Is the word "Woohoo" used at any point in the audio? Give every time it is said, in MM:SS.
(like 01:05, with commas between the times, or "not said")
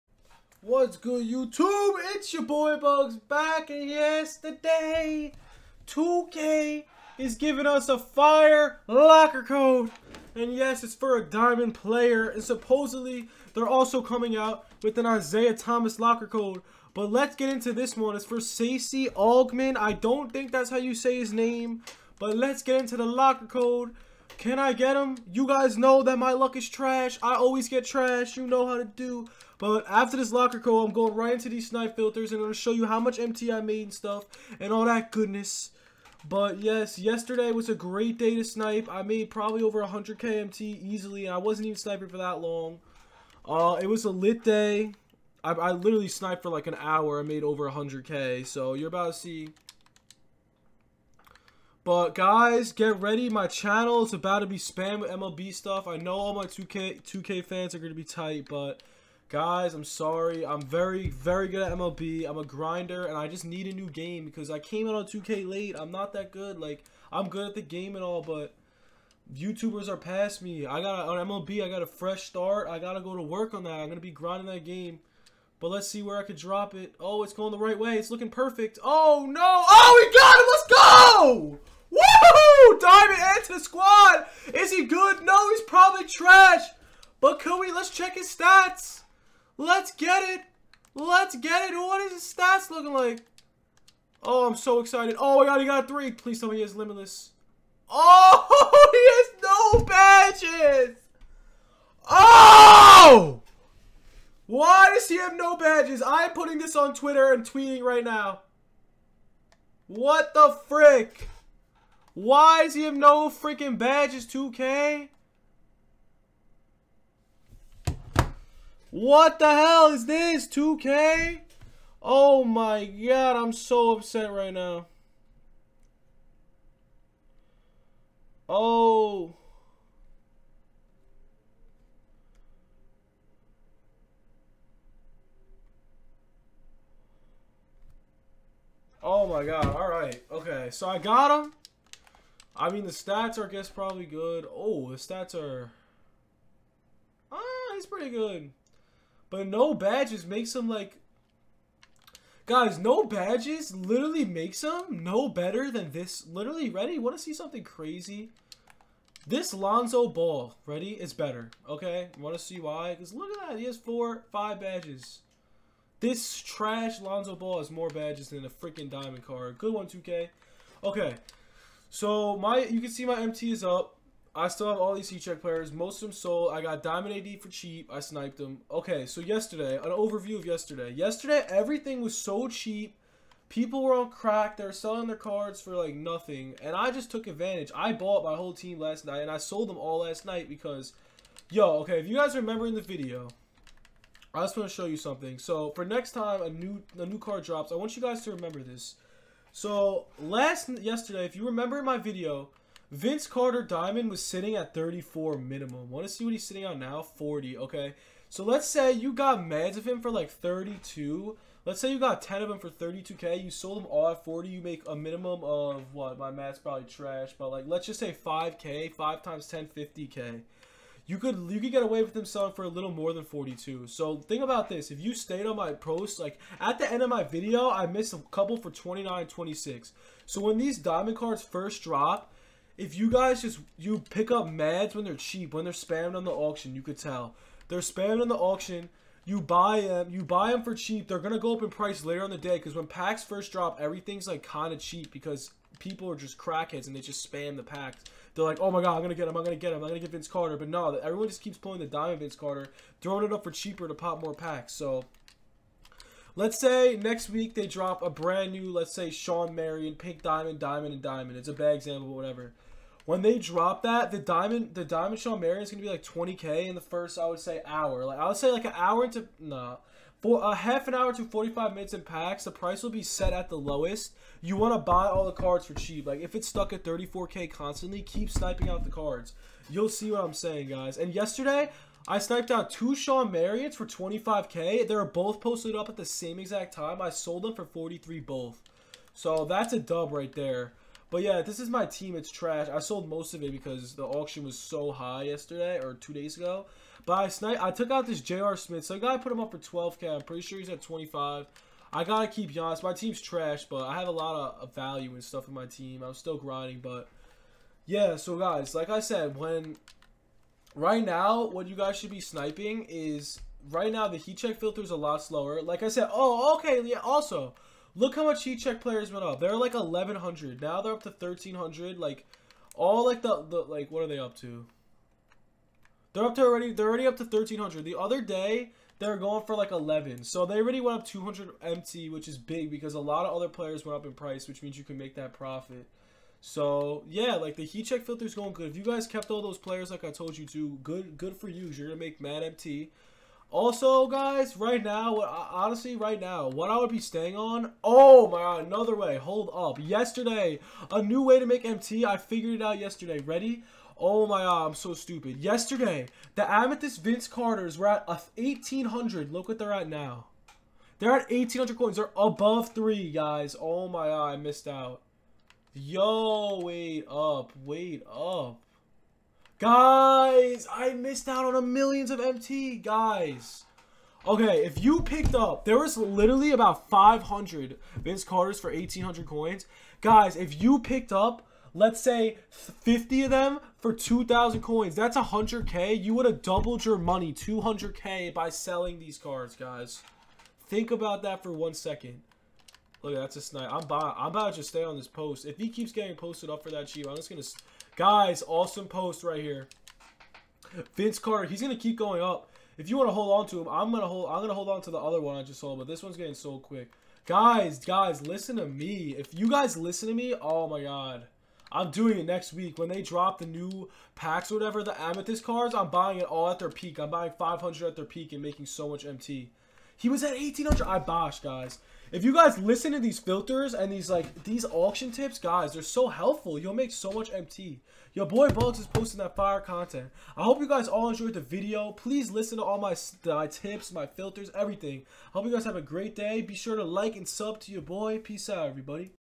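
01:21.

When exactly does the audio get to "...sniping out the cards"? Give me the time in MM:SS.
04:38.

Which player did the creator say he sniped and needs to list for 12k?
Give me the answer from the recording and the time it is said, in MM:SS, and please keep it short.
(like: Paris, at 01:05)
J.R. Smith, at 04:58.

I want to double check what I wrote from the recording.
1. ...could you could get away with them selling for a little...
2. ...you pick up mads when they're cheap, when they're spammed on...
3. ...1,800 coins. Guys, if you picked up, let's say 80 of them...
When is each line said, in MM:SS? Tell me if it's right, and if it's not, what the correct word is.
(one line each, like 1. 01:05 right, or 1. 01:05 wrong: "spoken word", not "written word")
1. 03:41 right
2. 03:53 right
3. 06:18 wrong: "50", not "80".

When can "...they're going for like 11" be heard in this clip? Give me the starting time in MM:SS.
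05:28.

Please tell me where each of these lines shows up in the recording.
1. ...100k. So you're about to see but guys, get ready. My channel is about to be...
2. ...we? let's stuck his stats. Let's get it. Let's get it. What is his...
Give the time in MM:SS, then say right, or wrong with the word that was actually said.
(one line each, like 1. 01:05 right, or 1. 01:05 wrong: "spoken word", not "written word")
1. 00:47 right
2. 01:27 wrong: "check", not "stuck".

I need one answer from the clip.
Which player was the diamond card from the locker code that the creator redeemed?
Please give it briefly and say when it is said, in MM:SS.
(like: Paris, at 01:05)
Stacey Augmon, at 00:18.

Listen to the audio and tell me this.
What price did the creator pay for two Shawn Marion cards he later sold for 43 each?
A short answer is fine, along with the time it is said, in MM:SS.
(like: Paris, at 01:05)
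25k, at 04:43.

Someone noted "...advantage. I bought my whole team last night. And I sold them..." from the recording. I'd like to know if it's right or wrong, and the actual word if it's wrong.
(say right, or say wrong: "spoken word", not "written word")
right.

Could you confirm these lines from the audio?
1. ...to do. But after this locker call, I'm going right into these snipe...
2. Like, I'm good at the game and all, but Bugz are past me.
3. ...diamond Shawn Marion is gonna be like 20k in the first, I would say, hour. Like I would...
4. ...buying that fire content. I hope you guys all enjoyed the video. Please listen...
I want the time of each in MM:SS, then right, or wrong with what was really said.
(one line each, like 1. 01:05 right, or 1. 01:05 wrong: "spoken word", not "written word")
1. 00:28 right
2. 01:06 wrong: "YouTubers", not "Bugz"
3. 04:24 right
4. 07:08 wrong: "posting", not "buying".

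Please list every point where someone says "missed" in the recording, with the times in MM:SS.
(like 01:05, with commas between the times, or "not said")
03:47, 06:04, 06:10.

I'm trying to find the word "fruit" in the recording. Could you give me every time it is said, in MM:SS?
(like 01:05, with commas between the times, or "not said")
not said.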